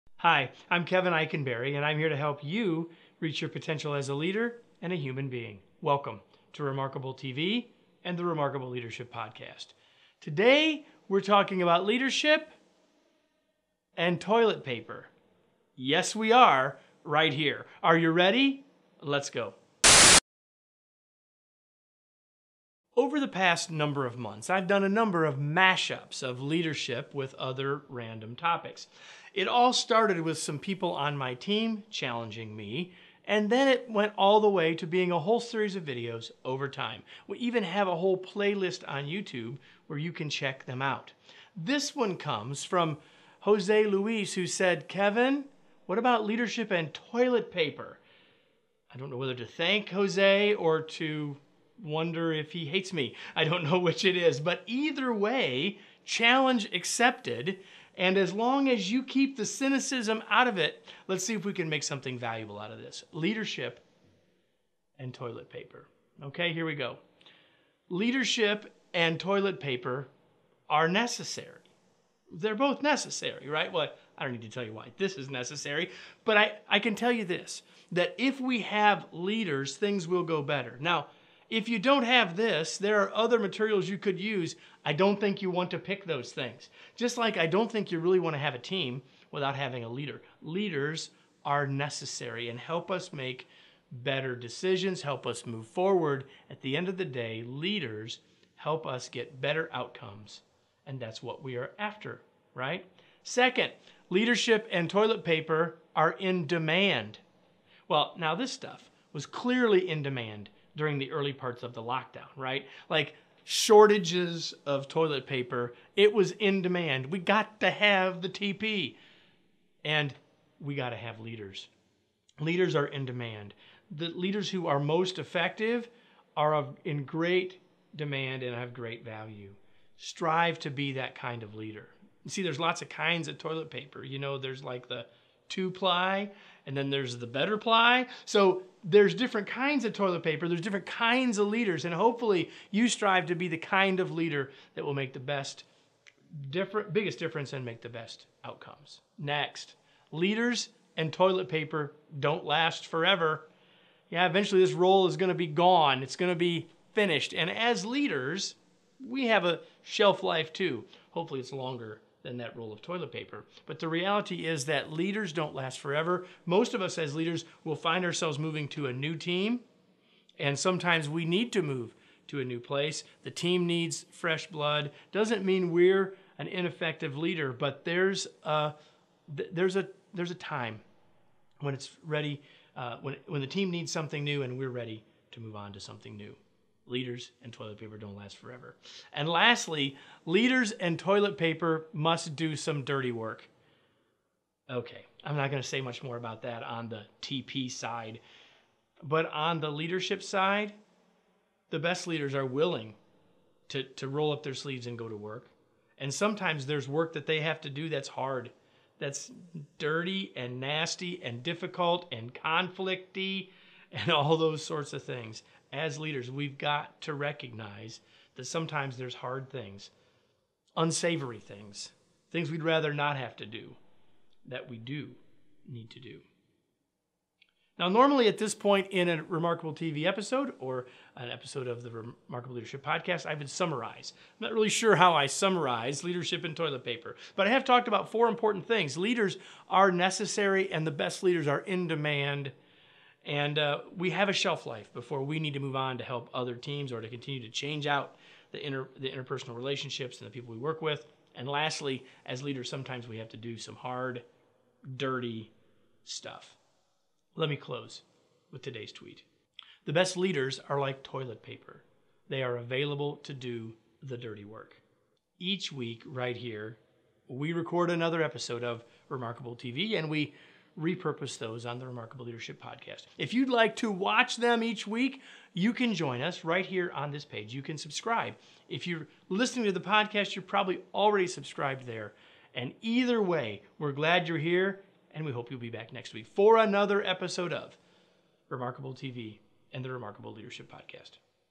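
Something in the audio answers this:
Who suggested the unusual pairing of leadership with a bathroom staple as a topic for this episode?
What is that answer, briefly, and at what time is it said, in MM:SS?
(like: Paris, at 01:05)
Jose Luis, at 00:43.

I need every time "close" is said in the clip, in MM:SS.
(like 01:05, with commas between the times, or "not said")
04:17.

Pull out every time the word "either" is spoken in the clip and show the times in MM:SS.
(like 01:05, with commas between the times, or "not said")
00:54, 04:42.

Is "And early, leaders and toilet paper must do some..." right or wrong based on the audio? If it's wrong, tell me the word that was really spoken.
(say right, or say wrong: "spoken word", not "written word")
wrong: "lastly", not "early".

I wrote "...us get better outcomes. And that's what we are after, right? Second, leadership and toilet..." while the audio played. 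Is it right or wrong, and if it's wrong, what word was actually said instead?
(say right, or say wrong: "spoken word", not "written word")
right.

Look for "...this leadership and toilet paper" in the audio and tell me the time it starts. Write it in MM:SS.
01:02.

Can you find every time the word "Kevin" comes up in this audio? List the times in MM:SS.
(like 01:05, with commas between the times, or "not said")
00:00, 00:44.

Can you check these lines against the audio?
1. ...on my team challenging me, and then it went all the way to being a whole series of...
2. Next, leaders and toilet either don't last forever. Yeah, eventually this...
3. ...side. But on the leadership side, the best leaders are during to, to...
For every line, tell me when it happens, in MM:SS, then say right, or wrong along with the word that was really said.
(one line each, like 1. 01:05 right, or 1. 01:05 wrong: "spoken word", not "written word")
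1. 00:30 right
2. 02:29 wrong: "paper", not "either"
3. 03:17 wrong: "willing", not "during".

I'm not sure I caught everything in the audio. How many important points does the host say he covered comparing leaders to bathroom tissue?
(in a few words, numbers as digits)
4.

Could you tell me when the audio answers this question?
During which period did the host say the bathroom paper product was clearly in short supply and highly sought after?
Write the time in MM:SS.
01:51.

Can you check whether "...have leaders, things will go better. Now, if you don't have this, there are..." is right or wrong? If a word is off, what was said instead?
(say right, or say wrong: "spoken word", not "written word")
right.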